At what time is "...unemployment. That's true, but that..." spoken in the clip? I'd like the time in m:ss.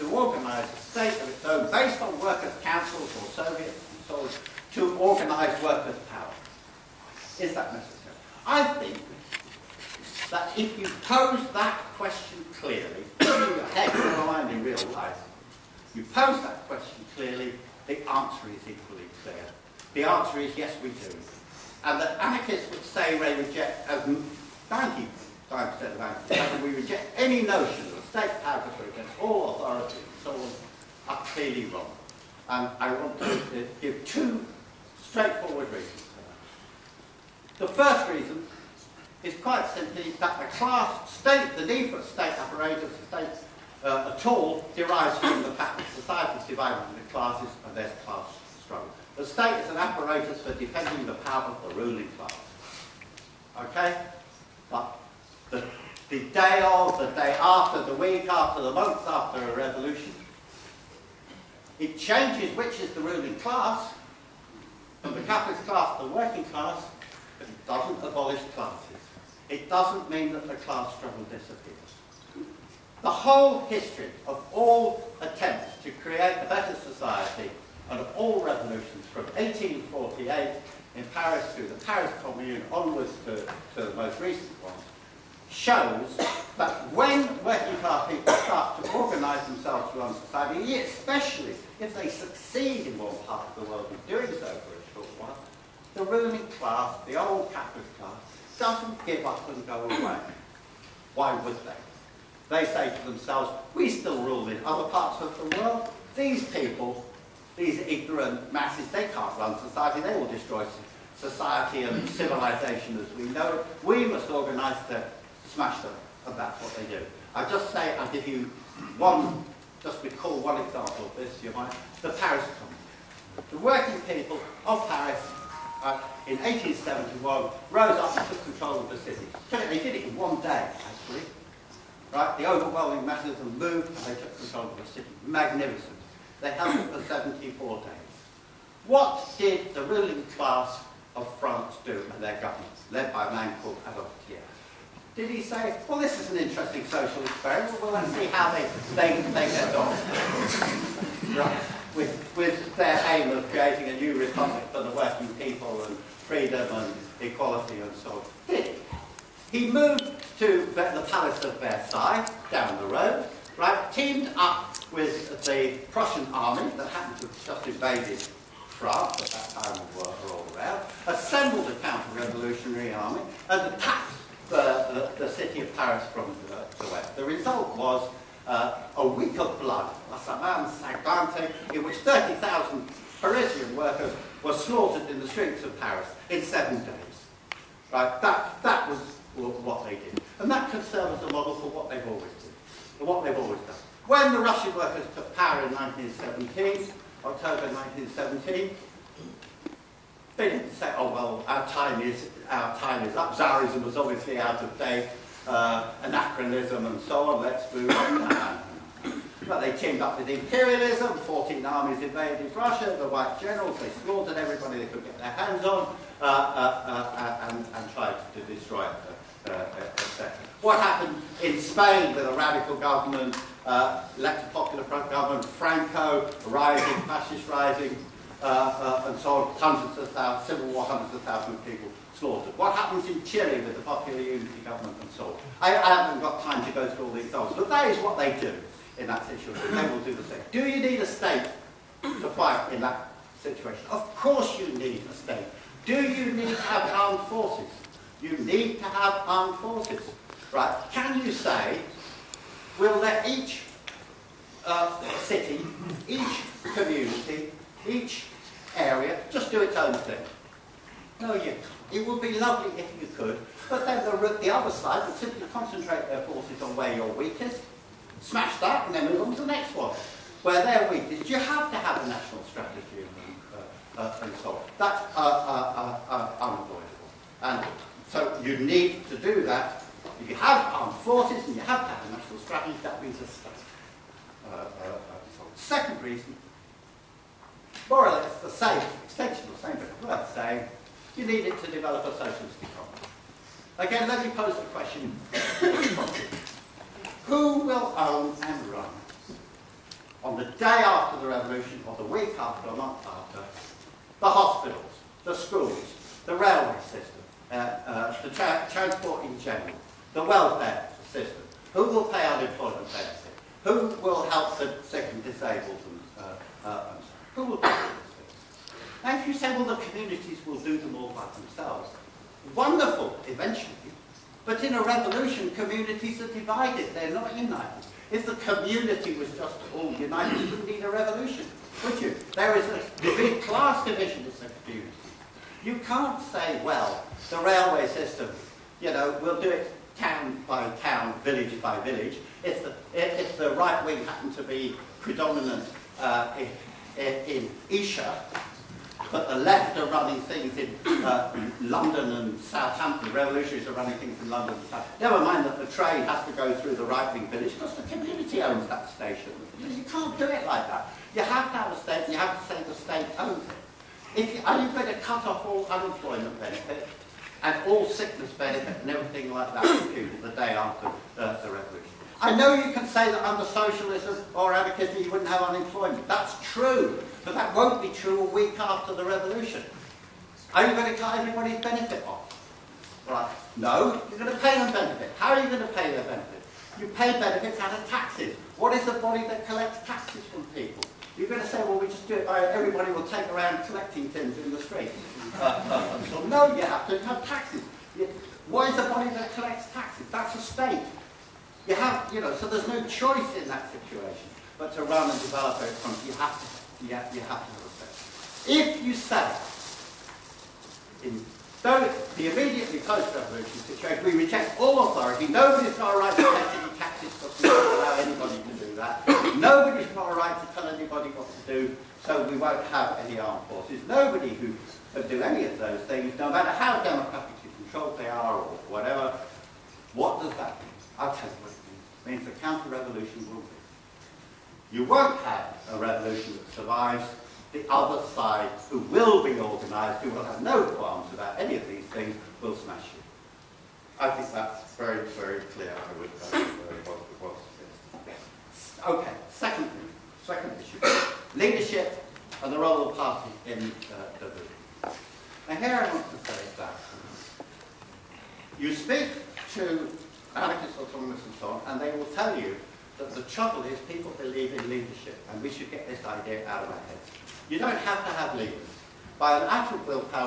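6:15.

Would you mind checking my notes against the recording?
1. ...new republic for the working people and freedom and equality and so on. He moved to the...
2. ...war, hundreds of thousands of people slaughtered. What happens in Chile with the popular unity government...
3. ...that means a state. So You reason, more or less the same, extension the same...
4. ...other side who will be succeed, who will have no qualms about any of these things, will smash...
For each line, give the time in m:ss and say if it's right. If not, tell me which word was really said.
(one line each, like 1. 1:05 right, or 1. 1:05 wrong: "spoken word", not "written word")
1. 2:33 right
2. 3:50 right
3. 4:42 wrong: "Second", not "You"
4. 7:17 wrong: "organised", not "succeed".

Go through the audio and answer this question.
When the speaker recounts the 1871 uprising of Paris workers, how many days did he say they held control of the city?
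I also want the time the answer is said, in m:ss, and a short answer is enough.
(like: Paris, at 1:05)
74, at 2:17.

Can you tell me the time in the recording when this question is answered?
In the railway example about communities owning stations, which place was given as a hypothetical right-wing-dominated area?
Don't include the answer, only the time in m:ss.
5:47.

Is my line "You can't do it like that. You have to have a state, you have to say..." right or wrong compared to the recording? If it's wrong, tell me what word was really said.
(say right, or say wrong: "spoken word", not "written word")
right.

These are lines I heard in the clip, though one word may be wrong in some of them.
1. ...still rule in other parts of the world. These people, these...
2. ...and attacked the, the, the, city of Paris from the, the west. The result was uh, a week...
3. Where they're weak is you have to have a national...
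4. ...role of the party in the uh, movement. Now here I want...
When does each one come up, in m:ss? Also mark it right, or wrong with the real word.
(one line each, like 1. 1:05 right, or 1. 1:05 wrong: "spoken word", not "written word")
1. 1:43 right
2. 2:53 right
3. 4:30 right
4. 7:32 right.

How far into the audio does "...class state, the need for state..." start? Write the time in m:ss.
0:40.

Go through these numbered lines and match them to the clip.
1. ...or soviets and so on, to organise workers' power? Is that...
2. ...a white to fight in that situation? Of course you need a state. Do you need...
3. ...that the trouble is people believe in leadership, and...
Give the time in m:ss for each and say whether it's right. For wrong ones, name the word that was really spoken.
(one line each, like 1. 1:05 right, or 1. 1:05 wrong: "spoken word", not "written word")
1. 0:03 right
2. 4:00 wrong: "state", not "white"
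3. 7:43 right.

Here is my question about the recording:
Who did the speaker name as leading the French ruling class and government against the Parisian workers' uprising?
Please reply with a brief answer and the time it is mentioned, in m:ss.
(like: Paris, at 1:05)
Adolf Thiers, at 2:23.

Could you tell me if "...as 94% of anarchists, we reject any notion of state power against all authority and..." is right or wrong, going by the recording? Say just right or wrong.
wrong.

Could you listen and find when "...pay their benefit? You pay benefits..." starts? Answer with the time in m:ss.
6:25.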